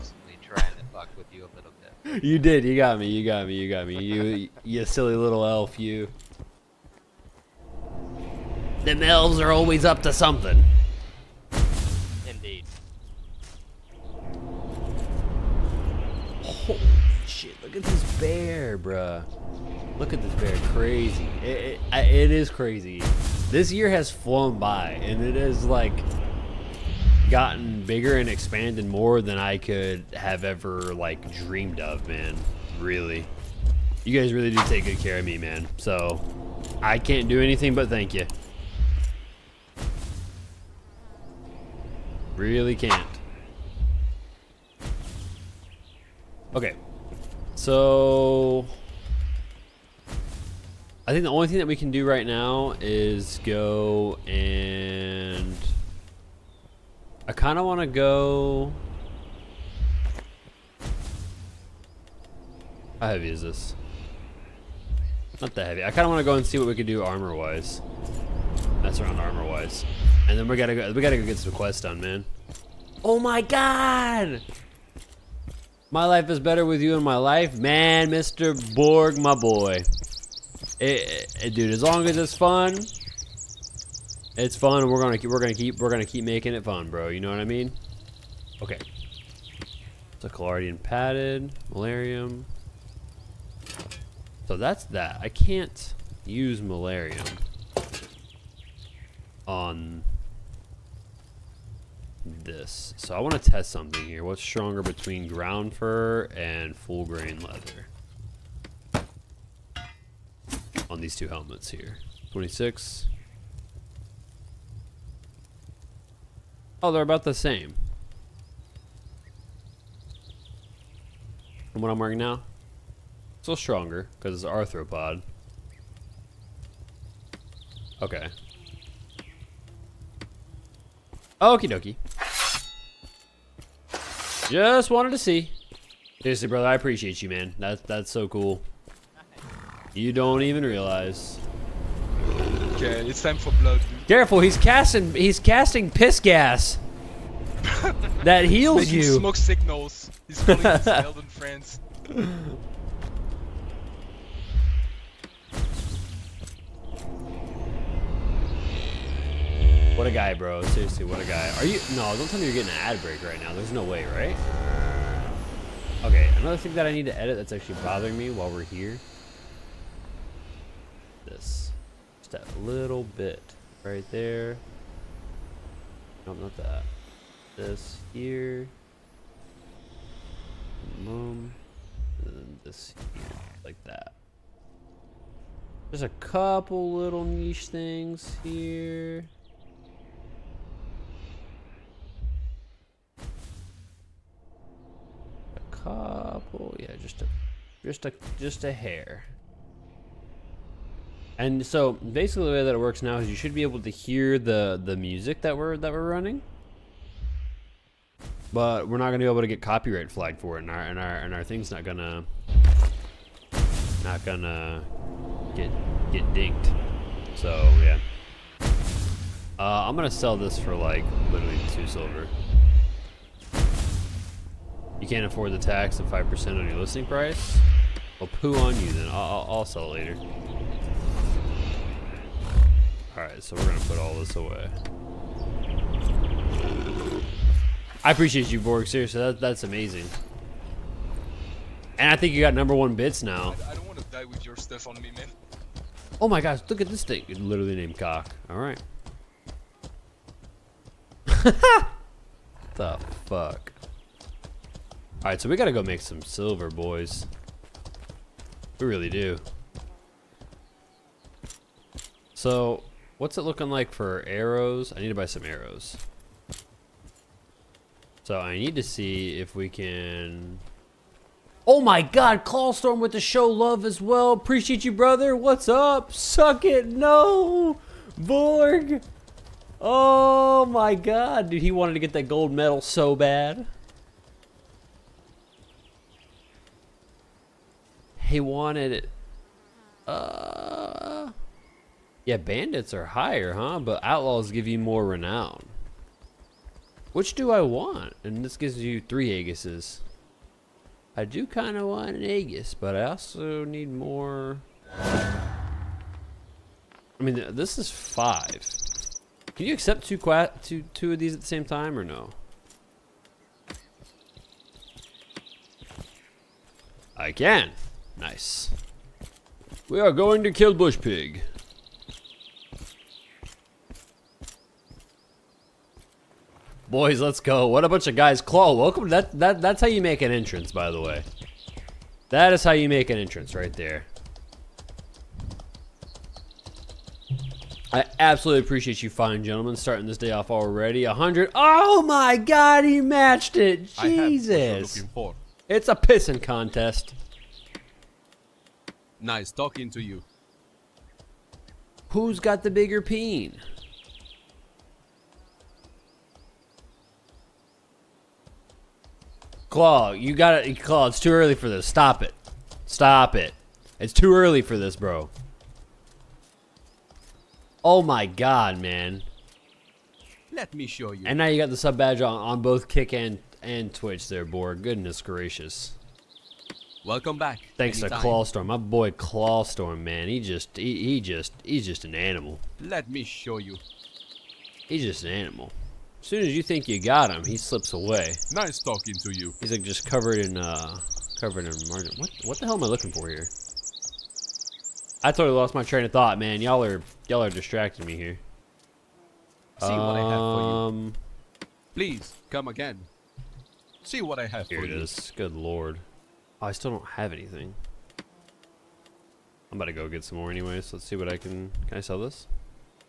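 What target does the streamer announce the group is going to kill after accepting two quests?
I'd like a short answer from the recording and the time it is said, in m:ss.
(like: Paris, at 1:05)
Bush Pig, at 5:20.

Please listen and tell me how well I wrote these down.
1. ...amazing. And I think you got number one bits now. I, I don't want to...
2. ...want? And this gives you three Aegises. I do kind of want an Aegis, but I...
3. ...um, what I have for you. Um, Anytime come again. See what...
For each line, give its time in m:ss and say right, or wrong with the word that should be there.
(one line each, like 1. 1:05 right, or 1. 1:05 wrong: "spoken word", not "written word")
1. 3:59 right
2. 4:57 right
3. 6:39 wrong: "Please", not "Anytime".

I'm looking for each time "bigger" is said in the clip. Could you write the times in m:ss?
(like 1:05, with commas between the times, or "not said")
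0:27, 5:52.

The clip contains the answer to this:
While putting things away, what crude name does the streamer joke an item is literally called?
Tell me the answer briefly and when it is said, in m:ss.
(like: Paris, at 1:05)
Cock, at 4:07.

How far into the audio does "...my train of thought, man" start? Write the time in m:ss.
6:35.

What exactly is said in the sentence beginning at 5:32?
That is how you make an entrance right there.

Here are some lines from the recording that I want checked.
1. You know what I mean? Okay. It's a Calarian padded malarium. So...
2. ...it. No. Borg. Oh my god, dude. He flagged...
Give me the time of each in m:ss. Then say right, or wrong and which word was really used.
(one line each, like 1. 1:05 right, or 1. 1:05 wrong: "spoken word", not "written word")
1. 1:27 right
2. 4:36 wrong: "wanted", not "flagged".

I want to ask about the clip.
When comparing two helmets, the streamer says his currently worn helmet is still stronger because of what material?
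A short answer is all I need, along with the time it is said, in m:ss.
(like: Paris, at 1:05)
arthropod, at 2:04.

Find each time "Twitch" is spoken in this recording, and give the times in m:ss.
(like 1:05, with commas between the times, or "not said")
6:13.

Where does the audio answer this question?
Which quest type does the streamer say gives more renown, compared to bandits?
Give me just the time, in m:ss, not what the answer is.
4:54.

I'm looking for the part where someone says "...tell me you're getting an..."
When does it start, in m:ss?
2:42.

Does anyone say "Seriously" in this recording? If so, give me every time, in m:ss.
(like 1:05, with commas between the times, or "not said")
2:16, 2:40, 3:58.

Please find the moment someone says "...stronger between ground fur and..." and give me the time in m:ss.
1:44.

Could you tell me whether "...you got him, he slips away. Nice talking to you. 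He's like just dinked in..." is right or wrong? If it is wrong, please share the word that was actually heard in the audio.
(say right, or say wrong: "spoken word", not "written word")
wrong: "covered", not "dinked".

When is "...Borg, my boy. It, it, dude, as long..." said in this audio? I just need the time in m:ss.
1:18.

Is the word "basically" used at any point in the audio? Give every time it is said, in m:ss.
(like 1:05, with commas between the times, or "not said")
3:21.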